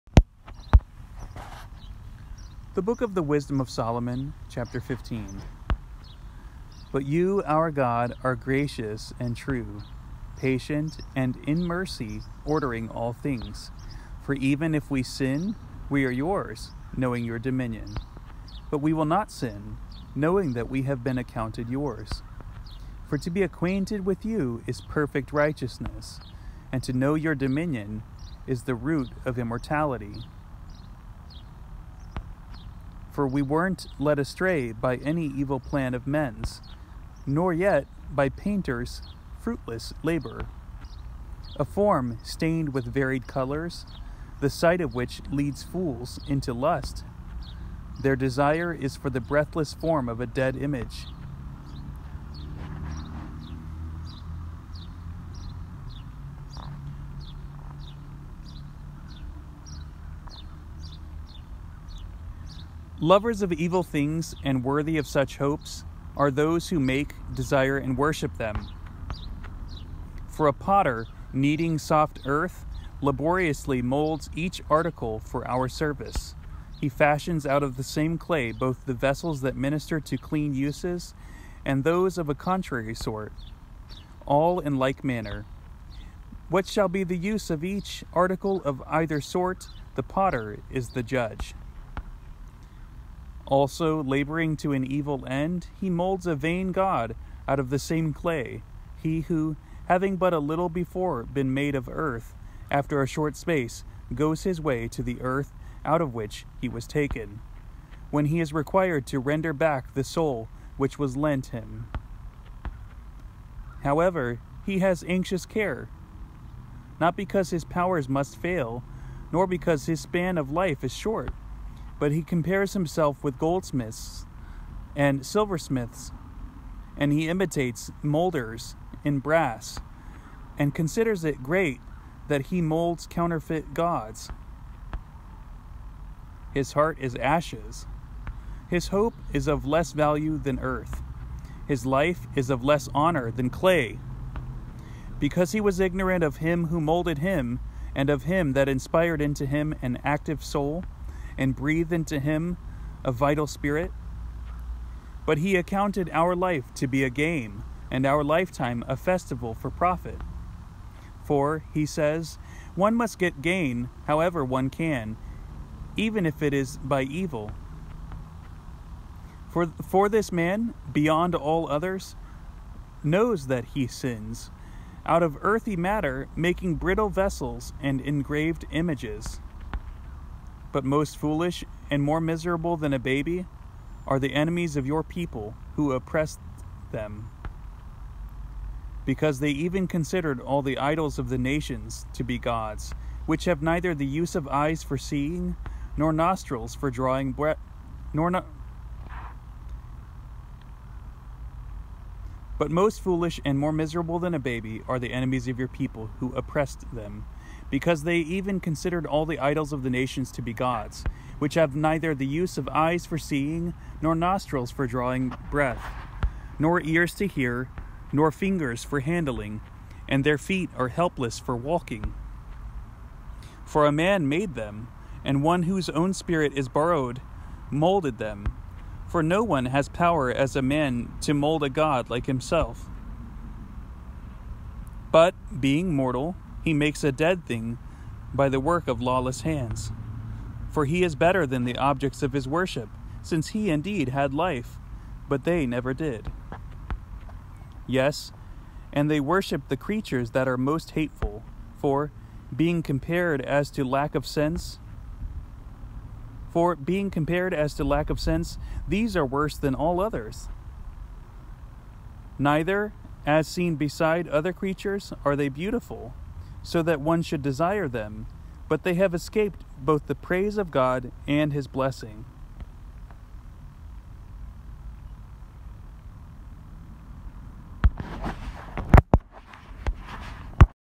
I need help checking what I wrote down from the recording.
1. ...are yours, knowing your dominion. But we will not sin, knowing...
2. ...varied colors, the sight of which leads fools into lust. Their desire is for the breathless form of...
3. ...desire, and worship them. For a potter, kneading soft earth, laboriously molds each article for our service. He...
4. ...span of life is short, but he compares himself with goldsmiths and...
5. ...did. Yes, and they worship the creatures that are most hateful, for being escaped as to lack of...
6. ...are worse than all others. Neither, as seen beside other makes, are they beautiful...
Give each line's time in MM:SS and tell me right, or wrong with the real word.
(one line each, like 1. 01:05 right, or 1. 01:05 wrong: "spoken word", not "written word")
1. 00:16 right
2. 00:42 right
3. 01:07 right
4. 01:59 right
5. 04:05 wrong: "compared", not "escaped"
6. 04:19 wrong: "creatures", not "makes".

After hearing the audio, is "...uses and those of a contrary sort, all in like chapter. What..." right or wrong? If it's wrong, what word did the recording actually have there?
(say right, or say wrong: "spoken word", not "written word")
wrong: "manner", not "chapter".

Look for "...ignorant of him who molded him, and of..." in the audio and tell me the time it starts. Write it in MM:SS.
02:25.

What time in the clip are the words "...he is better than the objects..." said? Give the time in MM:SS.
04:00.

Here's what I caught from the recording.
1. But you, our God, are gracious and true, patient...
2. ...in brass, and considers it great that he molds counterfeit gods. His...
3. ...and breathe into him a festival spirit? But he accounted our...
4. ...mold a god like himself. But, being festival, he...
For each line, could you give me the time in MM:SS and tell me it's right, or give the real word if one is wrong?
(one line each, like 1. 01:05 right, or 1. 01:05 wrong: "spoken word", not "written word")
1. 00:06 right
2. 02:09 right
3. 02:31 wrong: "vital", not "festival"
4. 03:51 wrong: "mortal", not "festival".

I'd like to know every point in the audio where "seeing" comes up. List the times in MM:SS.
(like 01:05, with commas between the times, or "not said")
03:14, 03:33.